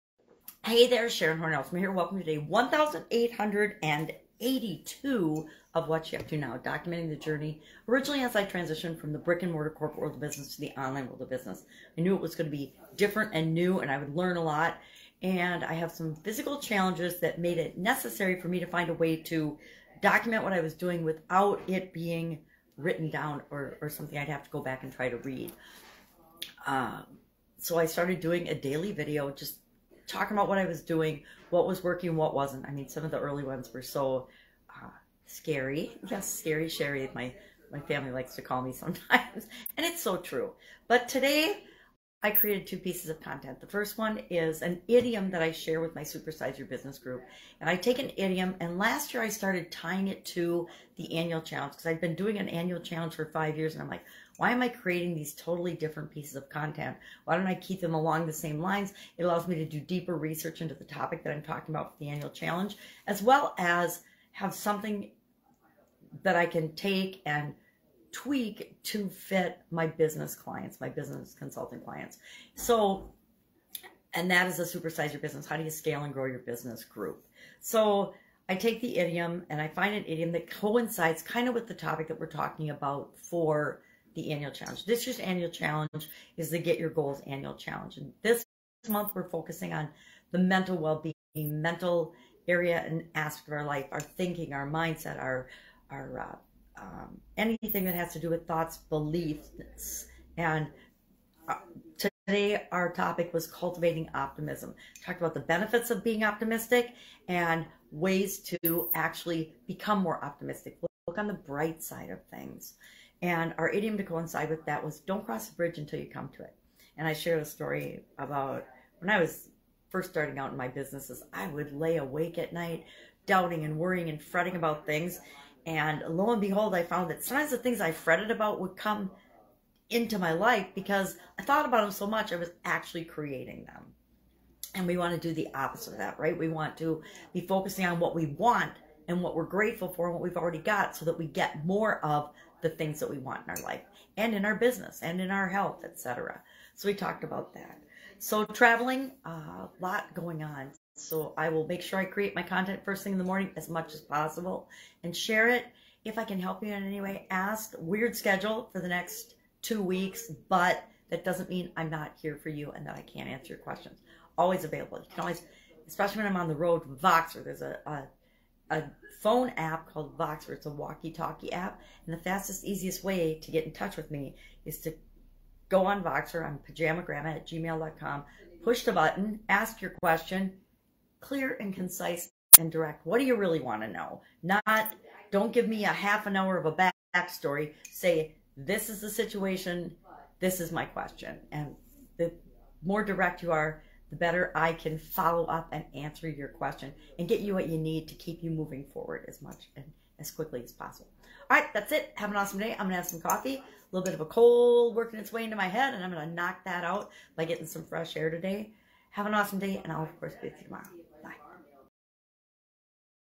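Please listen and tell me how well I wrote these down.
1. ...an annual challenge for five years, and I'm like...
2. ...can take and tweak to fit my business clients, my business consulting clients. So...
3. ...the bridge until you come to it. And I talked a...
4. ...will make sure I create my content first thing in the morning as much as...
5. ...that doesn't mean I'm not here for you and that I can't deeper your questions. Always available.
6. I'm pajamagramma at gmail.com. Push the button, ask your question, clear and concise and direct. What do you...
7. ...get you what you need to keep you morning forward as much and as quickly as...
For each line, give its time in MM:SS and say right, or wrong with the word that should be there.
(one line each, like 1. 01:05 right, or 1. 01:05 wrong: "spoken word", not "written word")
1. 00:52 right
2. 01:06 right
3. 01:55 wrong: "shared", not "talked"
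4. 02:31 right
5. 02:41 wrong: "answer", not "deeper"
6. 02:56 right
7. 03:17 wrong: "moving", not "morning".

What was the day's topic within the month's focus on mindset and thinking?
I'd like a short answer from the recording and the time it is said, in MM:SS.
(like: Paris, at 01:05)
cultivating optimism, at 01:43.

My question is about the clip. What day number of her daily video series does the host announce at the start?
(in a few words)
1882.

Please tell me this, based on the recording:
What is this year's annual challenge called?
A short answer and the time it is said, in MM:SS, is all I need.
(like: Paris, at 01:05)
Get Your Goals, at 01:26.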